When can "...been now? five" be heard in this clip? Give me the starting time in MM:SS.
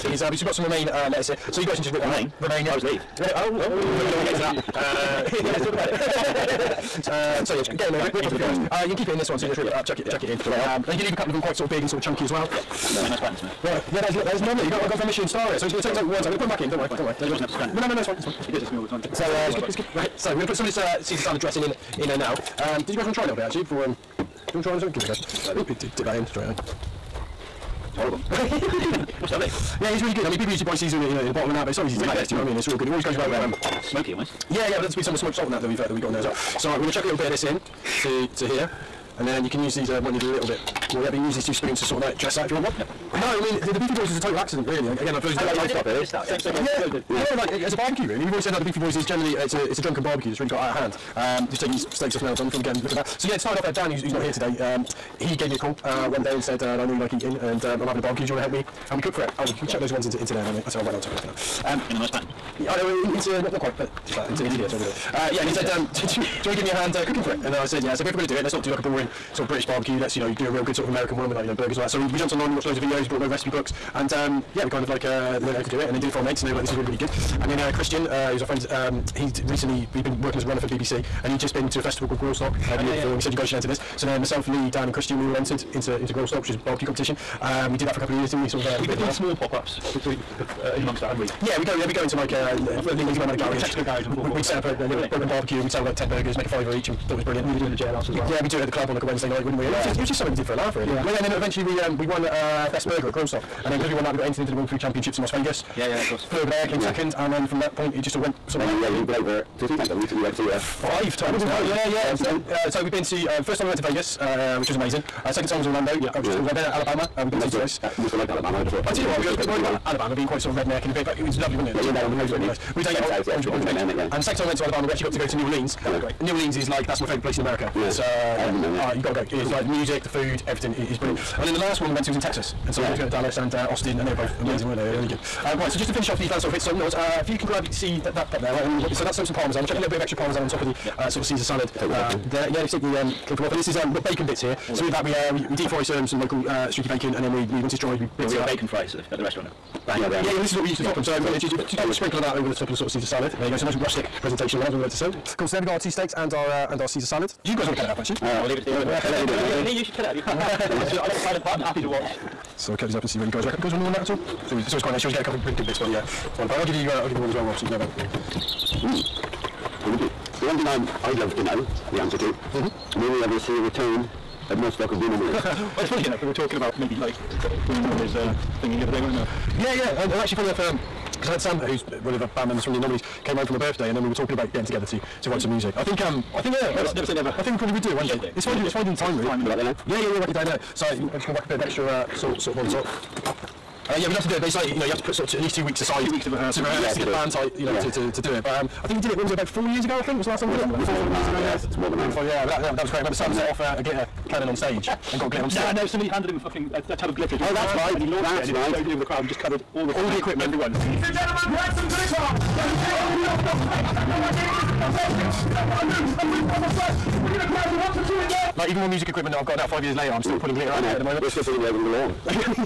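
01:51.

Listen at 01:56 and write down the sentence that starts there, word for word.
Then Alabama, we've been you to twice.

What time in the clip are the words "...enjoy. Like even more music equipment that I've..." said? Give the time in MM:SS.
03:38.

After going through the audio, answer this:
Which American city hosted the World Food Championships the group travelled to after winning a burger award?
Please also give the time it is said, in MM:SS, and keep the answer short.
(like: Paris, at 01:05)
Las Vegas, at 01:45.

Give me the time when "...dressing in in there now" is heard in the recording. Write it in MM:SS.
00:21.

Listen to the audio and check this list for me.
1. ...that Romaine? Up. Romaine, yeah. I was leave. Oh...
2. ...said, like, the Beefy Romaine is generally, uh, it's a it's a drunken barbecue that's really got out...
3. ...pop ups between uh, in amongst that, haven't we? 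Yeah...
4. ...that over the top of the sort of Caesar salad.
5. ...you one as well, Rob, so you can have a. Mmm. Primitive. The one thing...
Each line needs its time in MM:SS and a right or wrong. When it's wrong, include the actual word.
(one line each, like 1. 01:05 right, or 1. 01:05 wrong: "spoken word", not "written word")
1. 00:02 right
2. 00:48 wrong: "Boys", not "Romaine"
3. 01:29 right
4. 02:32 right
5. 02:47 right.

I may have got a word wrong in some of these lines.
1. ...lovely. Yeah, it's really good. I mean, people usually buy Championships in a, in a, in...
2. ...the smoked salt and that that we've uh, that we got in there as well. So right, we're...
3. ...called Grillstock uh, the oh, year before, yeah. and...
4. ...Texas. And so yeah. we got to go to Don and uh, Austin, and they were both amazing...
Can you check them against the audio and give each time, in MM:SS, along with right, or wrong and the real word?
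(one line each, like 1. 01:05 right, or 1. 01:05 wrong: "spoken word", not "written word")
1. 00:29 wrong: "Caesar", not "Championships"
2. 00:35 right
3. 01:22 right
4. 02:12 wrong: "Dallas", not "Don".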